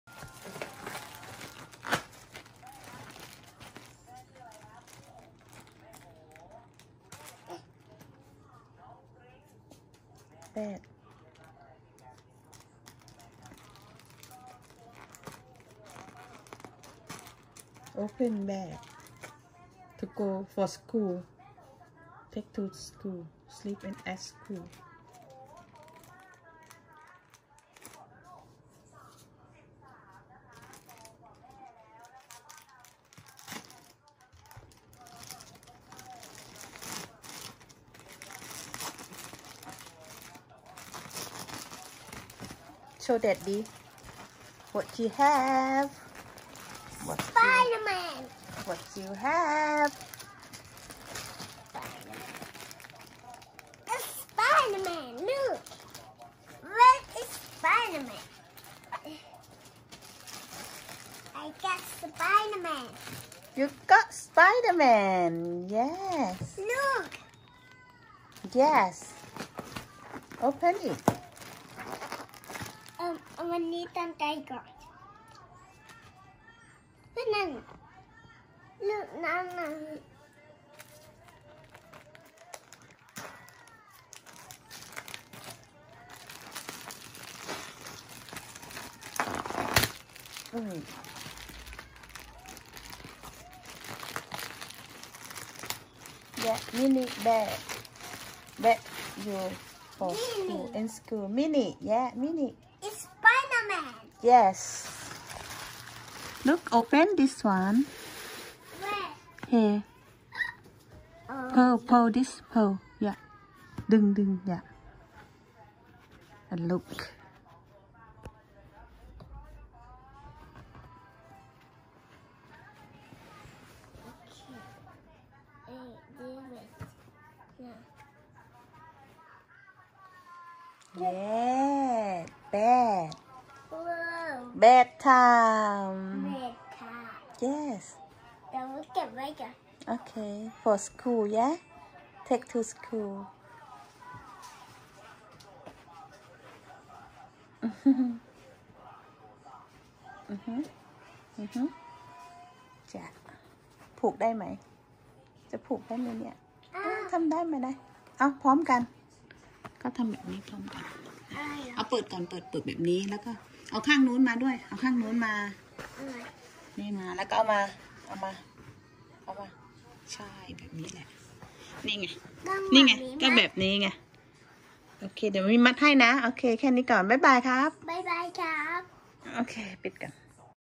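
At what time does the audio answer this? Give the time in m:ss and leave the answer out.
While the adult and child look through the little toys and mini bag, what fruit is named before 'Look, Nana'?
1:17.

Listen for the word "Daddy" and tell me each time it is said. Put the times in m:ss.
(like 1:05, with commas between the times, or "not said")
0:43.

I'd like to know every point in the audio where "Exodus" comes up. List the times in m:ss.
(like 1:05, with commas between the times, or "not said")
not said.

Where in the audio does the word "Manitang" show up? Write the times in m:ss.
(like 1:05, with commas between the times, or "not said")
1:13.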